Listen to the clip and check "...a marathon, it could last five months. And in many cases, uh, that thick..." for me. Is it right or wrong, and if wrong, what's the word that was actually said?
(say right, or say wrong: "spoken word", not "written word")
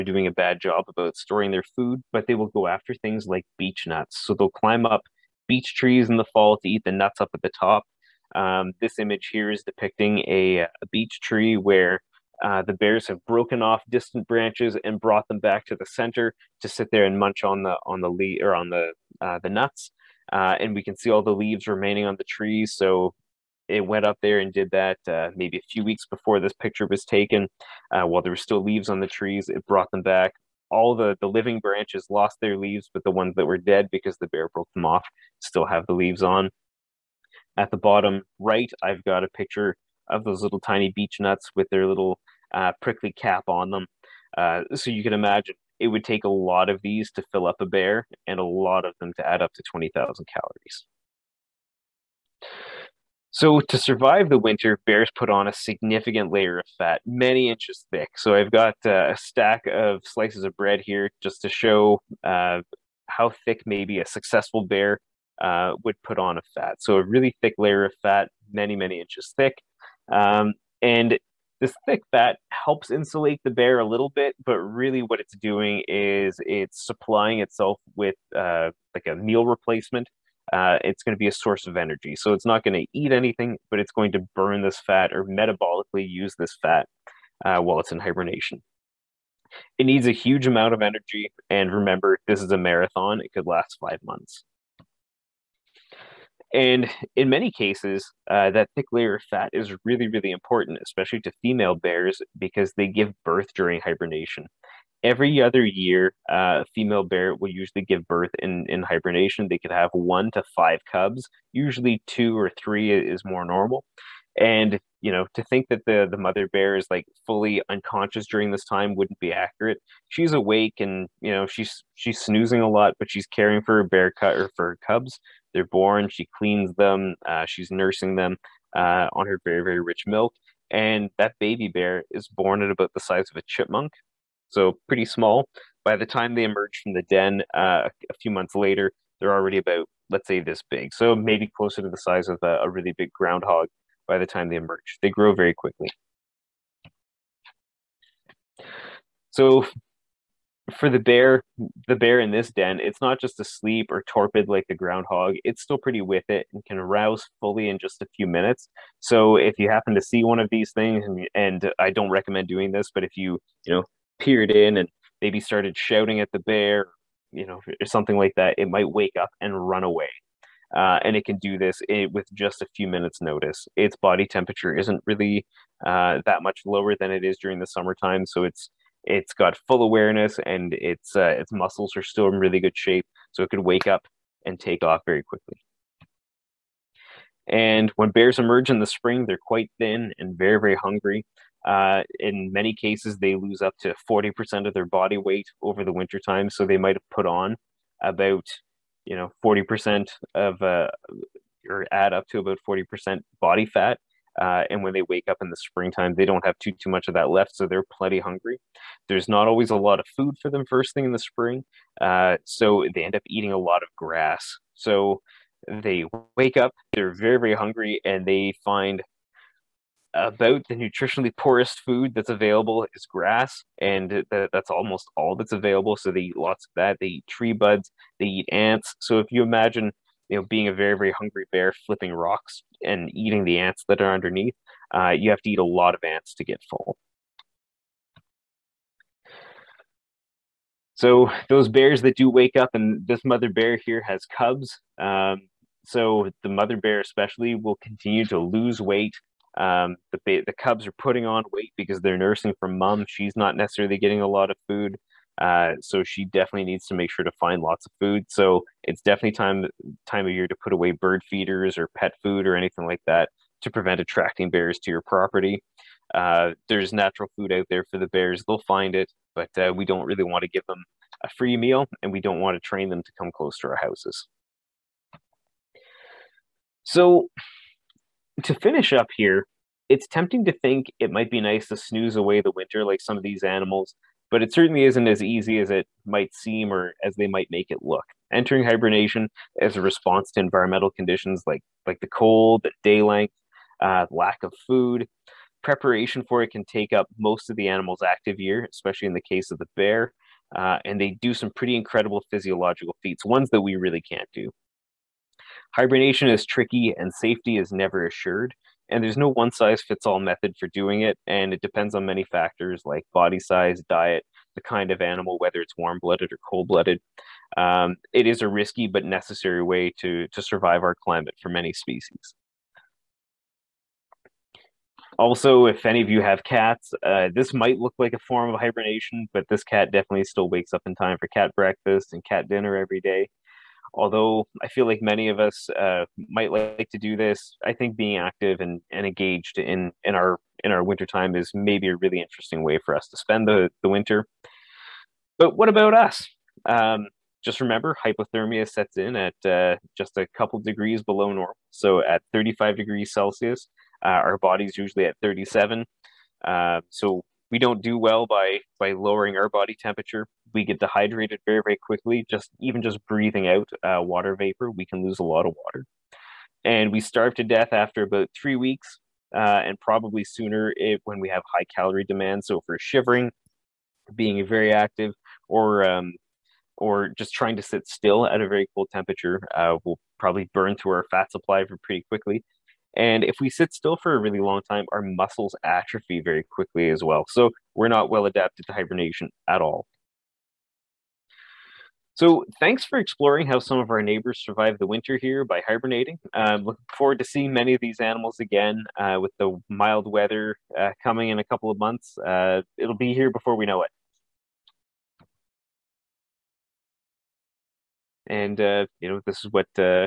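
right.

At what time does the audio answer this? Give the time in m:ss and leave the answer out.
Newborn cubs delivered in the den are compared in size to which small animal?
2:13.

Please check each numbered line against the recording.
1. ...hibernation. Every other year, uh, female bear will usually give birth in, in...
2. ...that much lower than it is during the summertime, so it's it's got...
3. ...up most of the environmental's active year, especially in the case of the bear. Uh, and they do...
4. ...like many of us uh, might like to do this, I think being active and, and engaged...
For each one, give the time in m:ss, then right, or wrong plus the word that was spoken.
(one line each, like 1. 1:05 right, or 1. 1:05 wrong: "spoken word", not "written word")
1. 1:43 right
2. 2:56 right
3. 4:56 wrong: "animal", not "environmental"
4. 5:34 right.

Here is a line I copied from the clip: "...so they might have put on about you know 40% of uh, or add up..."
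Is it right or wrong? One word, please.
right.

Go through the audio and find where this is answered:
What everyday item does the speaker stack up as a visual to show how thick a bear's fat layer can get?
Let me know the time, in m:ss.
1:00.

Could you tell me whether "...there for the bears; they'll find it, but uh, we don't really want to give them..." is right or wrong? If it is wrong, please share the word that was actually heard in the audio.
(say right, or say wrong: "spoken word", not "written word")
right.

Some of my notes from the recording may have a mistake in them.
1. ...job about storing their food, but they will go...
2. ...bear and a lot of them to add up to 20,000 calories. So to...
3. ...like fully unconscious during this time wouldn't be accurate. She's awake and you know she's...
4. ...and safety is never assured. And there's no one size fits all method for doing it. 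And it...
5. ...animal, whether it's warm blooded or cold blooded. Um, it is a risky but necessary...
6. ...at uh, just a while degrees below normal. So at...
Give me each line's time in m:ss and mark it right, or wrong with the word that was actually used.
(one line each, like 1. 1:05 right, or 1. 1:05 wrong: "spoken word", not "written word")
1. 0:00 right
2. 0:47 right
3. 1:56 right
4. 5:06 right
5. 5:15 right
6. 5:49 wrong: "couple", not "while".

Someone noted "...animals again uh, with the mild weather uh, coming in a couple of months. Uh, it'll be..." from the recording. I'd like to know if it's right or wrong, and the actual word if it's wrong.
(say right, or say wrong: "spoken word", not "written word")
right.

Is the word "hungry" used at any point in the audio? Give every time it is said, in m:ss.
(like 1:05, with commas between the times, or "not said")
3:10, 3:28, 3:37, 3:51.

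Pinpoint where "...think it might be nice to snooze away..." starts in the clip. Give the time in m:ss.
4:40.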